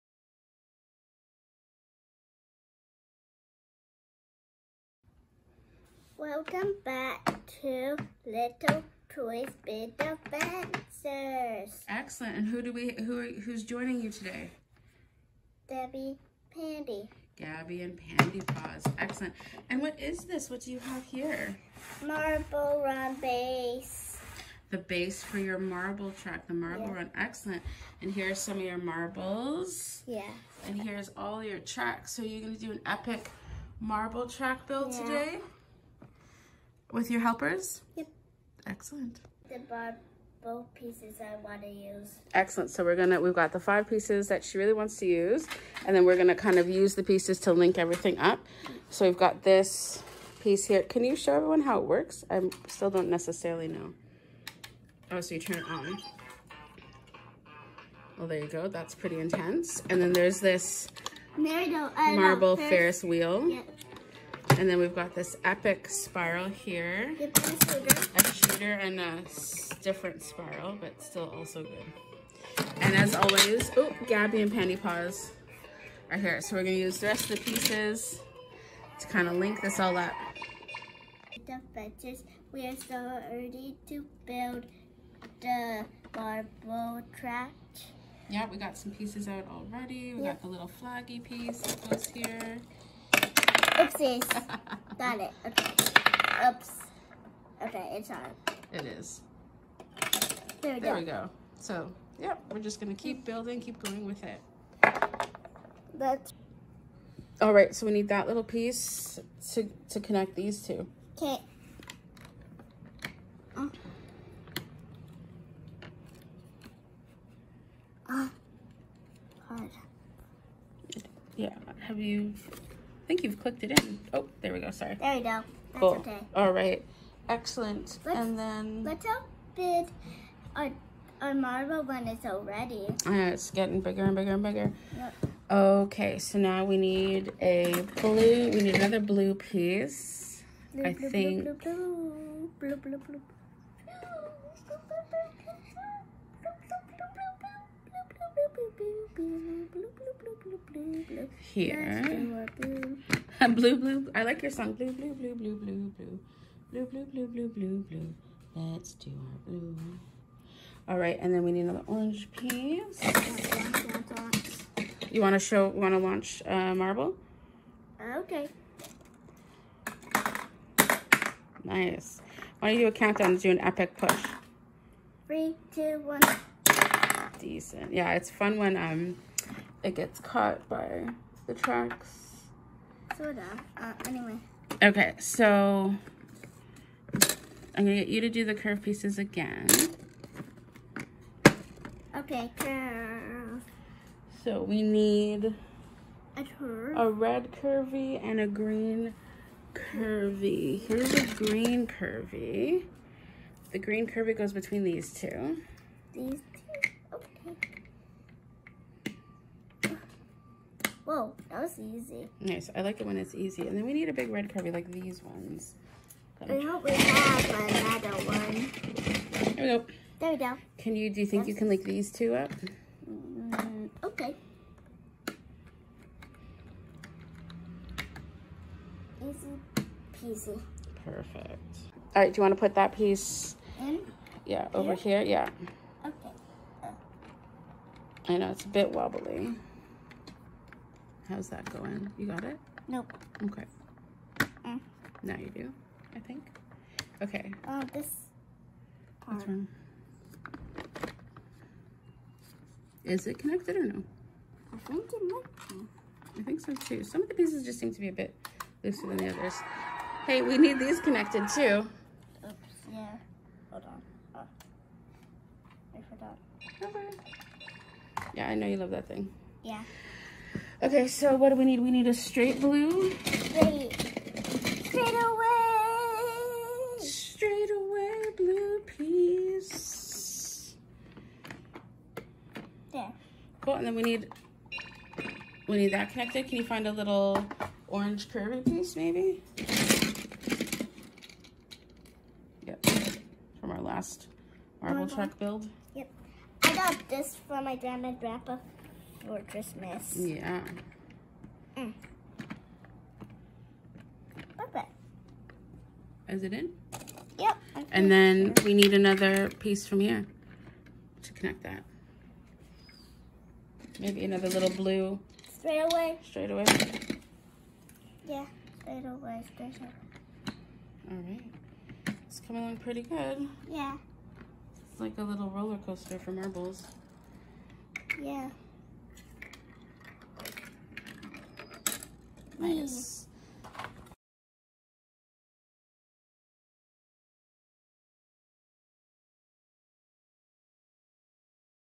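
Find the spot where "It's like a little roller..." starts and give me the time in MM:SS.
05:24.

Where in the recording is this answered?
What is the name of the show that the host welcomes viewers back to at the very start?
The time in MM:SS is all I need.
00:08.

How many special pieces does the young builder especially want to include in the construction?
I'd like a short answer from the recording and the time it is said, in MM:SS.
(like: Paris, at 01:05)
5, at 00:43.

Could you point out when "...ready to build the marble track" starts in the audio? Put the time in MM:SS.
01:23.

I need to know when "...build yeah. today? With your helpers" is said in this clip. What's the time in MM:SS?
00:34.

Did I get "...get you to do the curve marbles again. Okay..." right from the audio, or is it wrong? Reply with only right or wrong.
wrong.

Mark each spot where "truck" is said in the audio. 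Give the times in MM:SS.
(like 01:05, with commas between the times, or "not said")
04:55.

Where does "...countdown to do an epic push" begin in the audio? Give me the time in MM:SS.
02:52.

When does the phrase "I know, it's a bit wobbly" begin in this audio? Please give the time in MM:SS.
03:58.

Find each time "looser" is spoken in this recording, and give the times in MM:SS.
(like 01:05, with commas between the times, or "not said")
04:18.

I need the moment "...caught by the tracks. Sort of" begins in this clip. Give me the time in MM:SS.
03:00.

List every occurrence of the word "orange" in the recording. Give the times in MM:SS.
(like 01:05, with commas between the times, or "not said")
02:41, 04:47.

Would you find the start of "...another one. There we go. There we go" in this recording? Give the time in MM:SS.
03:37.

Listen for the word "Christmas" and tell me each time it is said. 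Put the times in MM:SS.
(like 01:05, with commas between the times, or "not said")
04:59.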